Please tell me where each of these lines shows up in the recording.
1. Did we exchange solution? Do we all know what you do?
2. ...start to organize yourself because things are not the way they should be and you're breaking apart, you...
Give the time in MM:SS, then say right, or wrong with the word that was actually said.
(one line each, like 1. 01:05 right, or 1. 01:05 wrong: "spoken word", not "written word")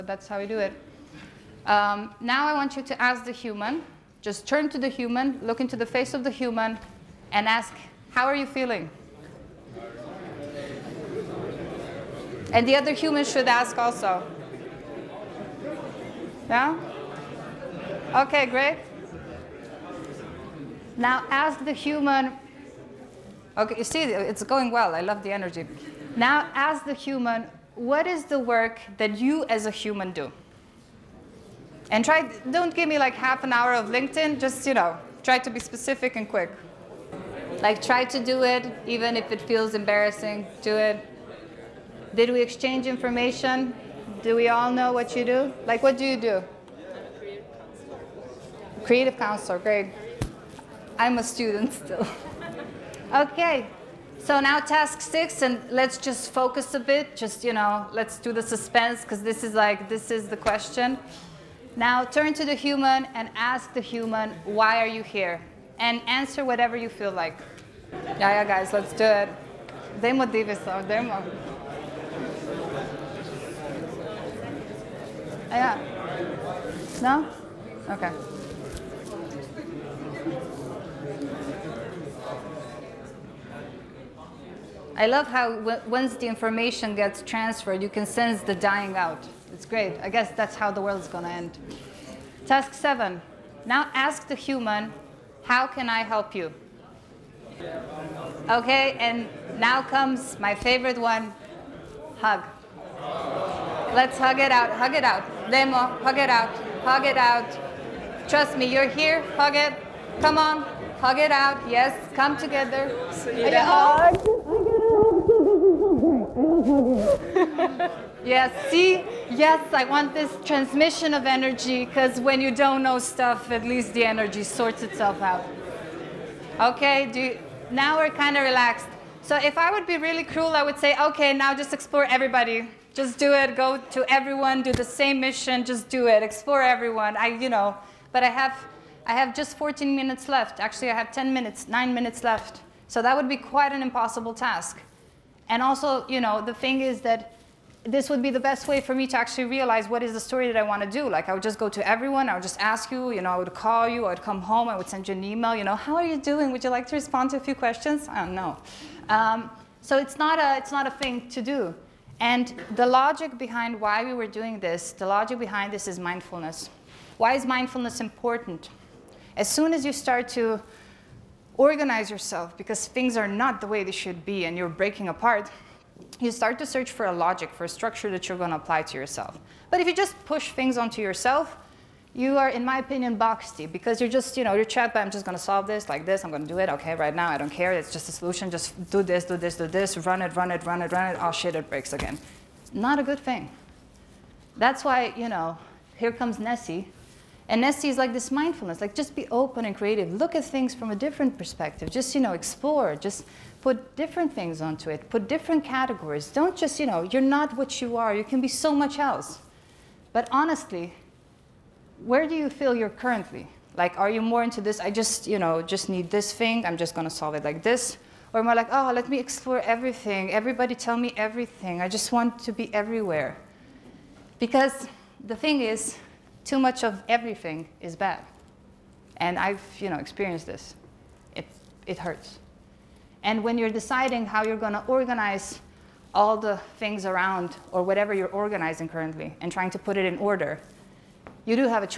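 1. 00:42 wrong: "information", not "solution"
2. 02:49 right.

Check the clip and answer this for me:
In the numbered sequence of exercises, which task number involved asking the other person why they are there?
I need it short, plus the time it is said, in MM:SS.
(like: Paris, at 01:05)
6, at 00:54.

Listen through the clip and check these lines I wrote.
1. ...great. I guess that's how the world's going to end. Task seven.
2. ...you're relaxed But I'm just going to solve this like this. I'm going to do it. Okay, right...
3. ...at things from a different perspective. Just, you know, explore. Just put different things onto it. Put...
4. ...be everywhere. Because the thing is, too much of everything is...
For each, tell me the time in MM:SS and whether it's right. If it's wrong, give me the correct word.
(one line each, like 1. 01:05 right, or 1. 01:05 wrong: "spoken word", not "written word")
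1. 01:29 right
2. 03:04 wrong: "trapped", not "relaxed"
3. 03:20 right
4. 03:42 right.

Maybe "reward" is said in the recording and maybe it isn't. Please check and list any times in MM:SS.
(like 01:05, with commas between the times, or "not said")
not said.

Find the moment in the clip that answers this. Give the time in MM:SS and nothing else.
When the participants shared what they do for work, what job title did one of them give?
00:48.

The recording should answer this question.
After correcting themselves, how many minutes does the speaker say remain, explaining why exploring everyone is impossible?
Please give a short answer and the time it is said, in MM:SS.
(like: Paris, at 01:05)
9, at 02:21.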